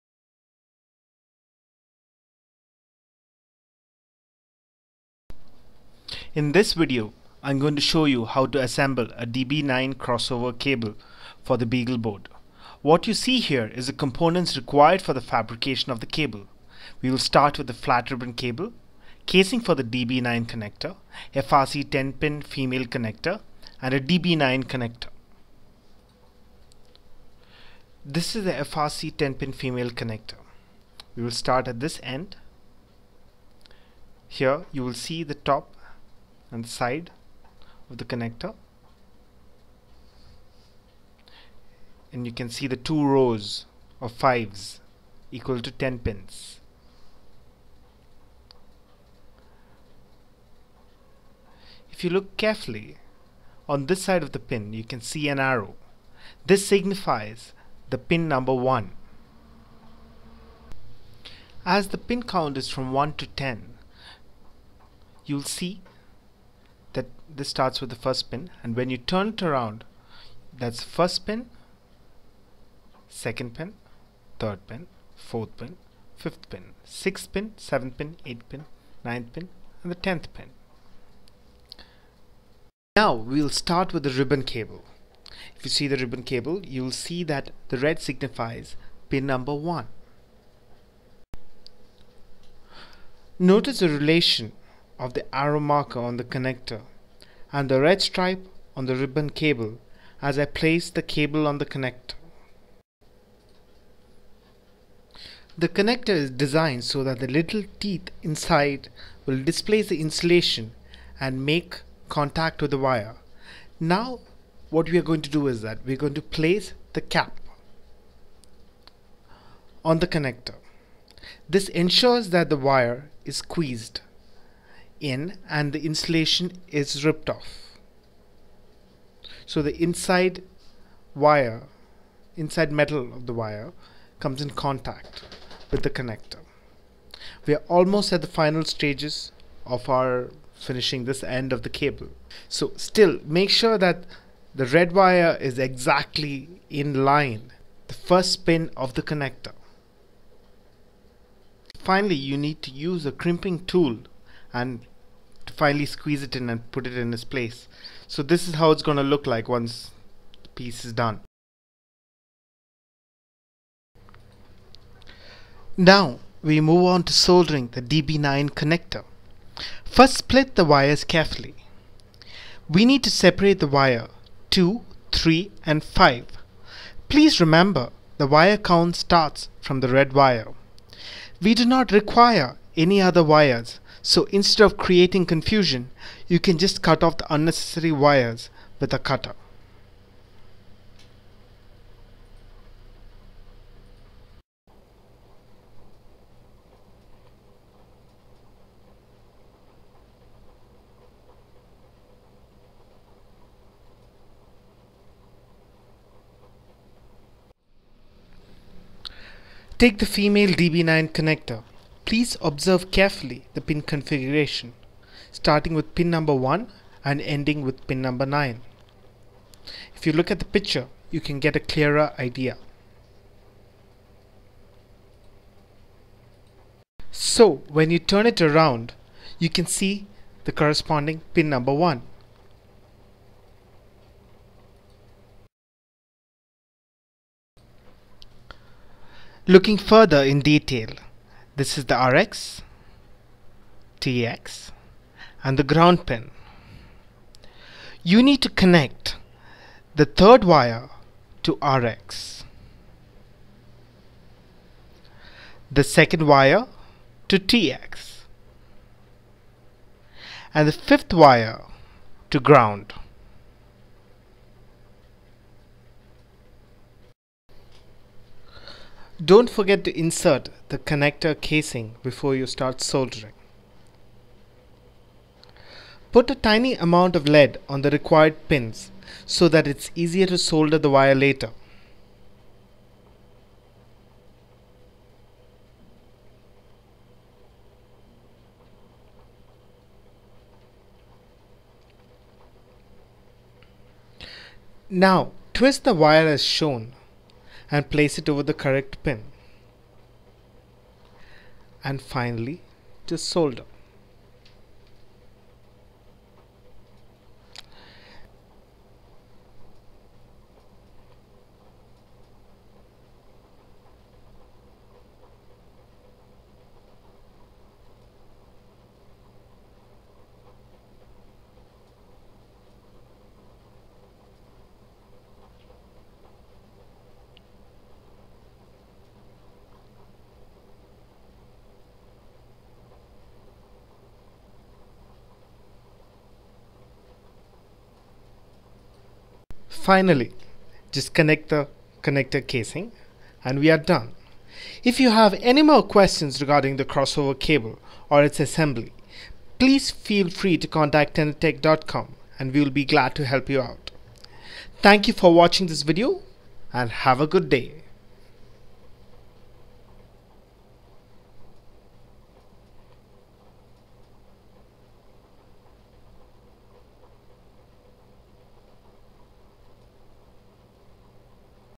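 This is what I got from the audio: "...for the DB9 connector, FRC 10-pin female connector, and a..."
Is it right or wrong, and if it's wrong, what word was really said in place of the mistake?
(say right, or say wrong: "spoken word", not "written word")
right.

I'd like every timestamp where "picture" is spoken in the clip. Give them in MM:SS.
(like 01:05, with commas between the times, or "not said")
03:40.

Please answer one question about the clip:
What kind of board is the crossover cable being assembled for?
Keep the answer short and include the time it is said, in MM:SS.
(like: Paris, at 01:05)
BeagleBoard, at 00:11.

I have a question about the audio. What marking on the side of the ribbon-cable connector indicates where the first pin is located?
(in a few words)
an arrow.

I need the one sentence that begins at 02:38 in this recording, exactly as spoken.
So this is how it's going to look like once the piece is done.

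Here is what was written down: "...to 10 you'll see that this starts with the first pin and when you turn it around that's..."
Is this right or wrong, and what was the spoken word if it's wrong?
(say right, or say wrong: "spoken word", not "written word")
right.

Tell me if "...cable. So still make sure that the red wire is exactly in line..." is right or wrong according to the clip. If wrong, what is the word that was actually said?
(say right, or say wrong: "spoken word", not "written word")
right.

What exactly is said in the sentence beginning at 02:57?
Please remember the wire count starts from the red wire.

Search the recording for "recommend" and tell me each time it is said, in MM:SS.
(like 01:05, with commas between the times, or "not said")
not said.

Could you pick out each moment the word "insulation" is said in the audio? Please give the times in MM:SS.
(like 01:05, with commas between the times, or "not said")
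01:49, 02:05.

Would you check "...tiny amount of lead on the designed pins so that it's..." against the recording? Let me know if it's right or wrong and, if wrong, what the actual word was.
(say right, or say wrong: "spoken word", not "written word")
wrong: "required", not "designed".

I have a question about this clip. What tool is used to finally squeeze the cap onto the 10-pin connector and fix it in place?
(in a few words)
crimping tool.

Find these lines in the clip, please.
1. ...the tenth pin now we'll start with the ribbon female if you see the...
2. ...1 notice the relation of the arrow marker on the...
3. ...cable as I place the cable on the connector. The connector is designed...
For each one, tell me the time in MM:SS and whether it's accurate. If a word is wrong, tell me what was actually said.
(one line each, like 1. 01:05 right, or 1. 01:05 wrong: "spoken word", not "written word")
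1. 01:19 wrong: "cable", not "female"
2. 01:29 right
3. 01:39 right.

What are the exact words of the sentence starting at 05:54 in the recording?
Thank you for watching this video and have a good day.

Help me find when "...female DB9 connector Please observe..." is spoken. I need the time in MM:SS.
03:30.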